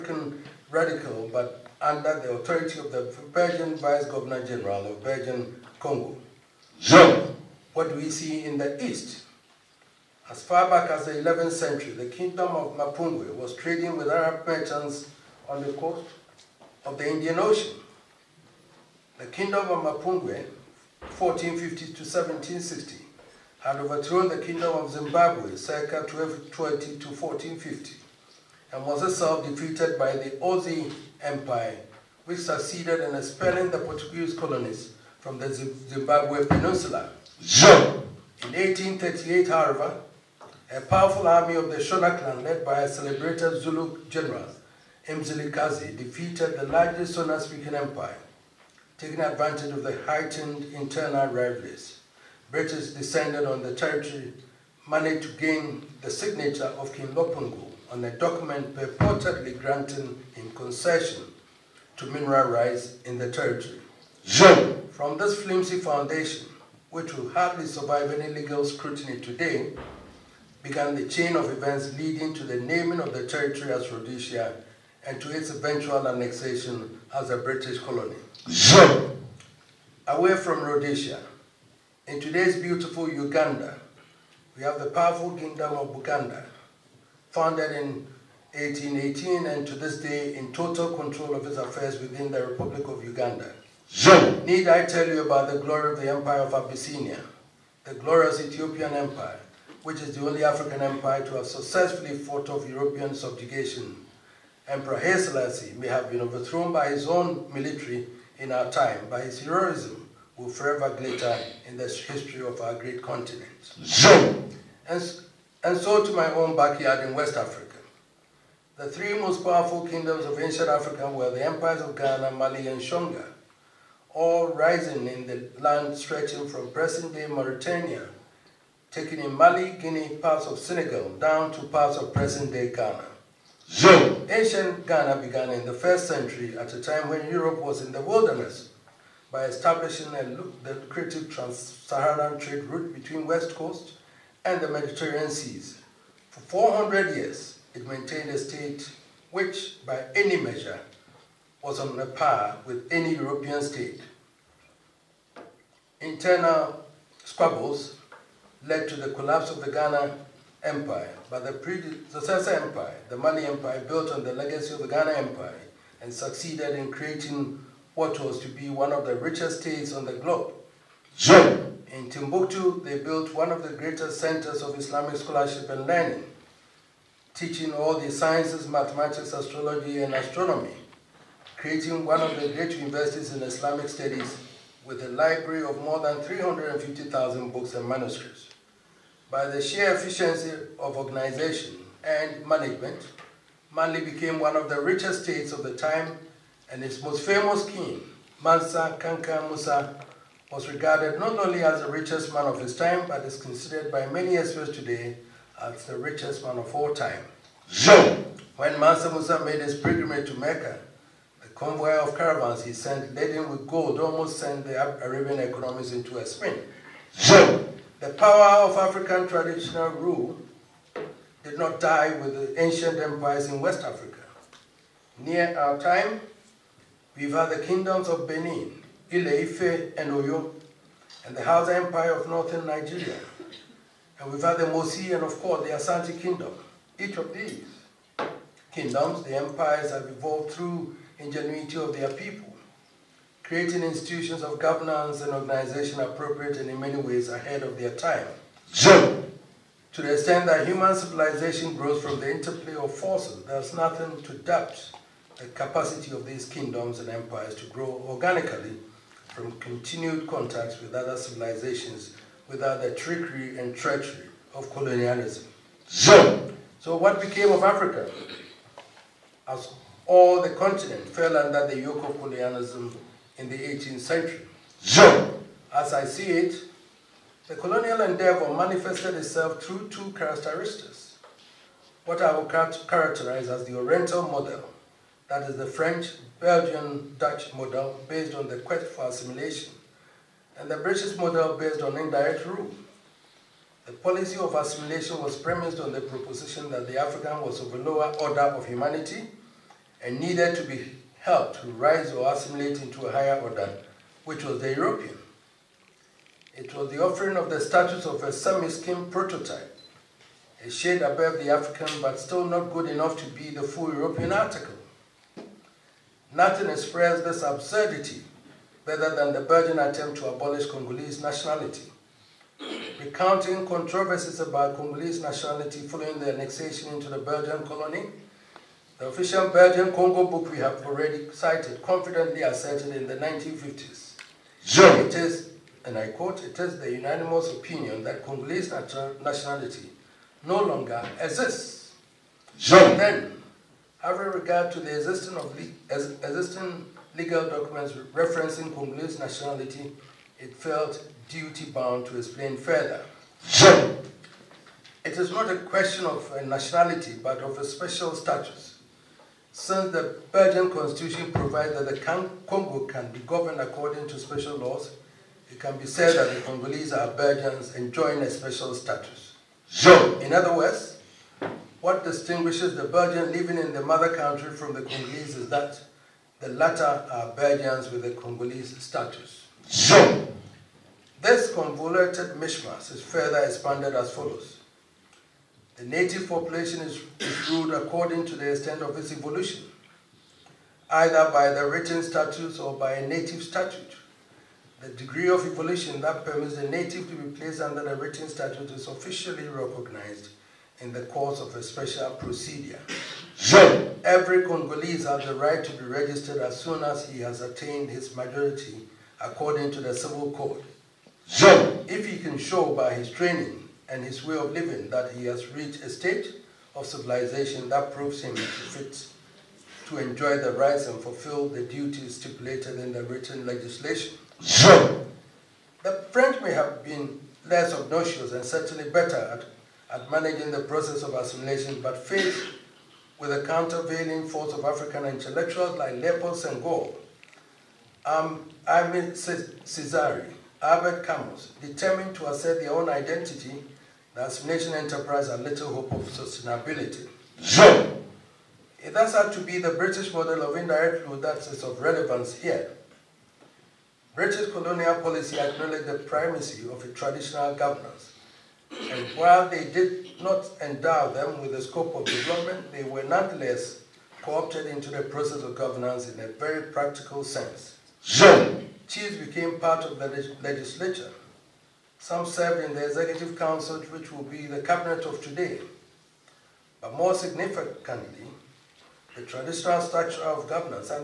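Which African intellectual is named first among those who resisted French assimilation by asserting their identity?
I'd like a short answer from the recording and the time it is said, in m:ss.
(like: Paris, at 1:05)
Leopold Senghor, at 7:15.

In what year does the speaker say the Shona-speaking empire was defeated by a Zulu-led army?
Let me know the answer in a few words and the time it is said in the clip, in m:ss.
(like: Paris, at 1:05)
1838, at 0:38.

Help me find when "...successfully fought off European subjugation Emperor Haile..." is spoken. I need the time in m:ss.
1:41.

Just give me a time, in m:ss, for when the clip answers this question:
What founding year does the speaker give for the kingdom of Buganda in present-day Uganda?
1:28.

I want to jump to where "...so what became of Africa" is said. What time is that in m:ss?
4:26.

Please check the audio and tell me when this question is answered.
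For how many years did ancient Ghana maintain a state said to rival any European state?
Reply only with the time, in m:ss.
2:26.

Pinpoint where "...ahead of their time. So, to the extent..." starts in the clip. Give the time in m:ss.
4:07.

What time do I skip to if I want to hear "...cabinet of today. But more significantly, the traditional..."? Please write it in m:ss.
7:54.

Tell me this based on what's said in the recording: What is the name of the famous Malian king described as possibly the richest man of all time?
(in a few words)
Mansa Kanka Musa.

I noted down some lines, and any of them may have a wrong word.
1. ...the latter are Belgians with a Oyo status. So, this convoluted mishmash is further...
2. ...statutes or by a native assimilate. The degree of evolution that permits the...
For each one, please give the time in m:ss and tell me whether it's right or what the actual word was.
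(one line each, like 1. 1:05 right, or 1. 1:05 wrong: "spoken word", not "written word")
1. 6:16 wrong: "Congolese", not "Oyo"
2. 6:32 wrong: "statute", not "assimilate".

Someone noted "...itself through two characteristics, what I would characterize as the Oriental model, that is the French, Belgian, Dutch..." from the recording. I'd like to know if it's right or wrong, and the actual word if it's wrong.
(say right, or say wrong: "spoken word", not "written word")
right.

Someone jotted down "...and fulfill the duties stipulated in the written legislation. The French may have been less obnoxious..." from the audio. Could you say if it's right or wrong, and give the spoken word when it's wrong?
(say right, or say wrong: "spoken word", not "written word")
right.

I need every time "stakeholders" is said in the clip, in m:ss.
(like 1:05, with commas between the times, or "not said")
not said.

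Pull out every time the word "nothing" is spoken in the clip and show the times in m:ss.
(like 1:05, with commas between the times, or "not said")
4:13, 5:16.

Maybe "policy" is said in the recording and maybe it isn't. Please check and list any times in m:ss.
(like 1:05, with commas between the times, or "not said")
4:53, 7:34.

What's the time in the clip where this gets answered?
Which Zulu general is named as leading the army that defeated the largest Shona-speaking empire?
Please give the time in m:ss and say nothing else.
0:45.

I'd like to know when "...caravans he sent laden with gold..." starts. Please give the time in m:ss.
3:32.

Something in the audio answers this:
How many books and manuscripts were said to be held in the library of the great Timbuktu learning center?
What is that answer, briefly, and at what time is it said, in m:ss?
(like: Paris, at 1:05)
350,000, at 3:06.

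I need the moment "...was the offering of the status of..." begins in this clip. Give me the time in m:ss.
5:06.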